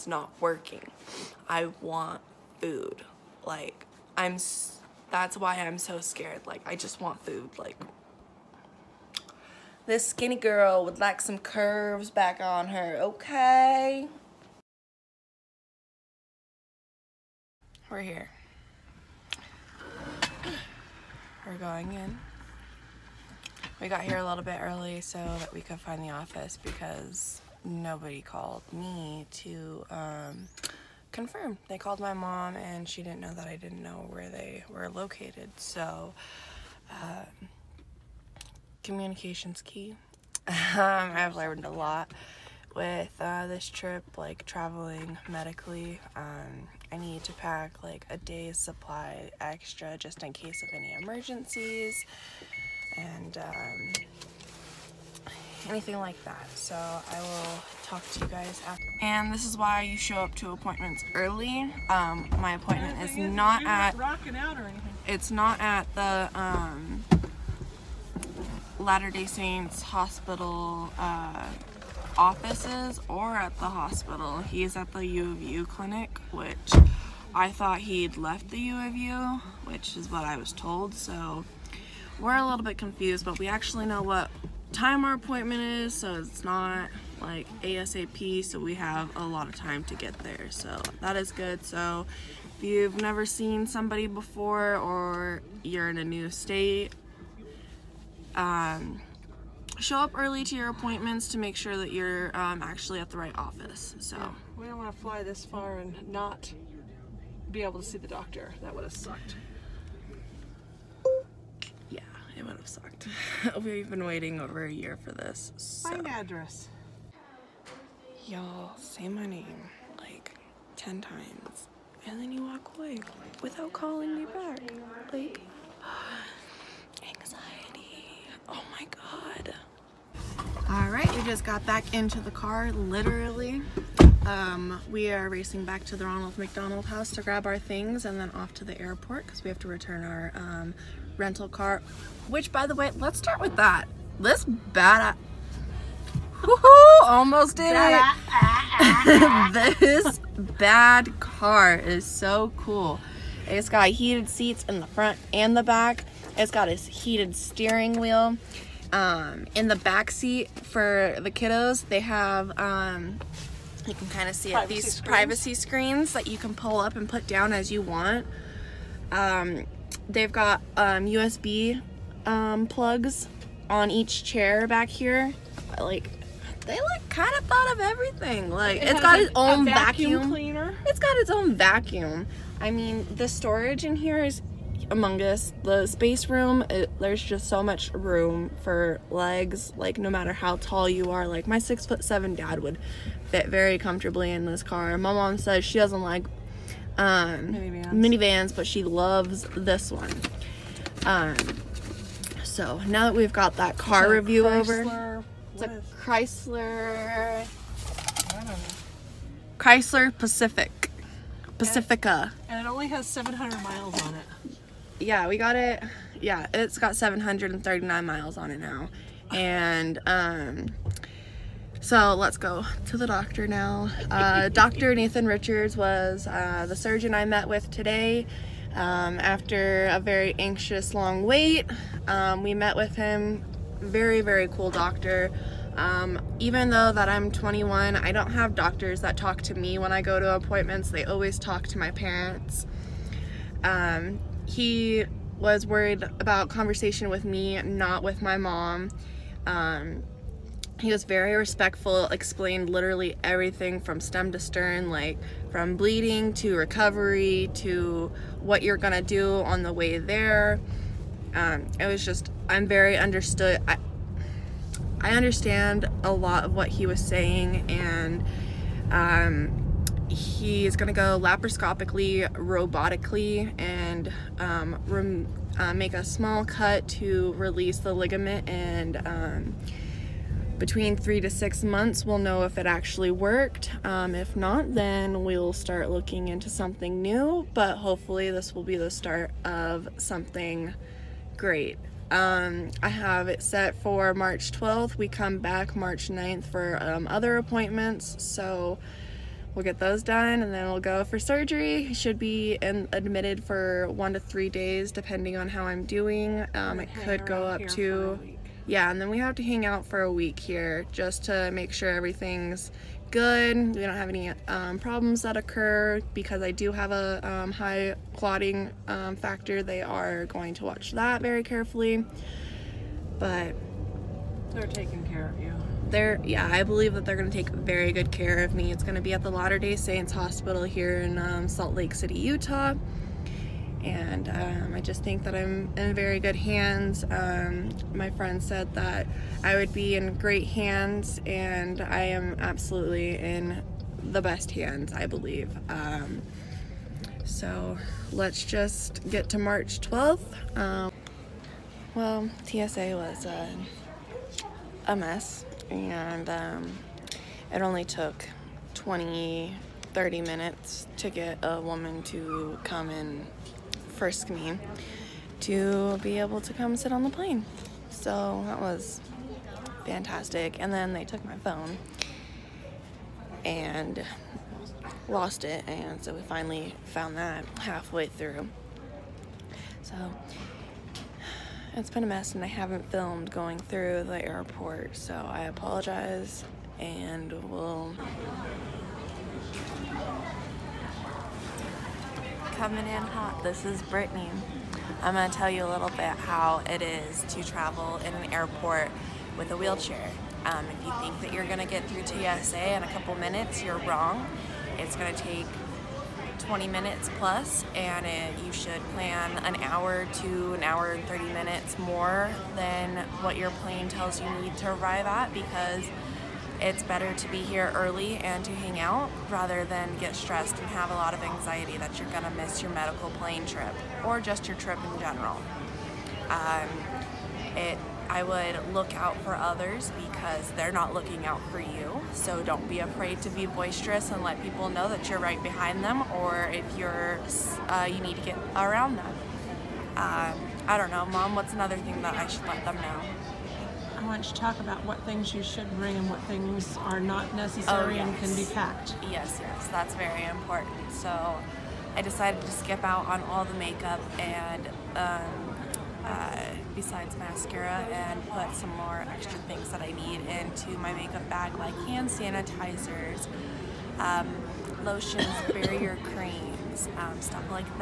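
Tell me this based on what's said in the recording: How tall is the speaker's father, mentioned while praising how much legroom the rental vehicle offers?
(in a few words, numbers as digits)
6 foot 7.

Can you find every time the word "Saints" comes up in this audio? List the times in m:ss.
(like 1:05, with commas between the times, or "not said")
1:09, 5:29.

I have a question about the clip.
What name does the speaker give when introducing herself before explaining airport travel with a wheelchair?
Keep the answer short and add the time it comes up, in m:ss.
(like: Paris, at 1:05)
Brittany, at 6:33.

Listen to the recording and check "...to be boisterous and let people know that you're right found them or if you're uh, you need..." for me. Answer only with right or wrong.
wrong.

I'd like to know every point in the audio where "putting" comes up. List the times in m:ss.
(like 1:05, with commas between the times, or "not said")
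not said.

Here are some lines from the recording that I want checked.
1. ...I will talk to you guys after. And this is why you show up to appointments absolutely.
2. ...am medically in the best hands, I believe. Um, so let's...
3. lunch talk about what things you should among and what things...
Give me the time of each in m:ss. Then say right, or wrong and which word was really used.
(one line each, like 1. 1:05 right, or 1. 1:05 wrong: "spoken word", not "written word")
1. 0:56 wrong: "early", not "absolutely"
2. 5:42 wrong: "absolutely", not "medically"
3. 7:24 wrong: "bring", not "among".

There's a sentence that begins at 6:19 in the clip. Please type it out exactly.
So it's been a mess and I haven't filmed going through the airport.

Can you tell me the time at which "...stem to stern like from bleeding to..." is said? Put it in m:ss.
4:13.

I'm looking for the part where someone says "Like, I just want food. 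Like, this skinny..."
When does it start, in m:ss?
0:06.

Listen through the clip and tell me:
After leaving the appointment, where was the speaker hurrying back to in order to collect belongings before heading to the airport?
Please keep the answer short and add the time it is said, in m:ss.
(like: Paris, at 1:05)
Ronald McDonald House, at 2:16.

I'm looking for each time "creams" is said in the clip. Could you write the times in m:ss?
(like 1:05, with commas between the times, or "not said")
7:46.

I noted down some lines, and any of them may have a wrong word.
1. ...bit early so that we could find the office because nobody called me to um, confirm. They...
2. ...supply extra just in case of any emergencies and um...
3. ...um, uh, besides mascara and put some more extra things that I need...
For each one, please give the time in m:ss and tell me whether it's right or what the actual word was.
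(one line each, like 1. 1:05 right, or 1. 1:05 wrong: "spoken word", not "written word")
1. 0:24 right
2. 0:48 right
3. 7:34 right.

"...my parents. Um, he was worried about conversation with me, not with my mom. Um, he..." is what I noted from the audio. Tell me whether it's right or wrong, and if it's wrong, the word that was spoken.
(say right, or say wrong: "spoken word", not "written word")
right.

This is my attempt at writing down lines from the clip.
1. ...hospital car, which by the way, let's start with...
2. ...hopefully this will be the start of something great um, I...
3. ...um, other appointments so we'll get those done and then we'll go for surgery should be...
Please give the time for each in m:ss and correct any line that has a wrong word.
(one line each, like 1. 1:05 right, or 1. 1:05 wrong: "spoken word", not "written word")
1. 2:21 wrong: "rental", not "hospital"
2. 4:47 right
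3. 4:56 right.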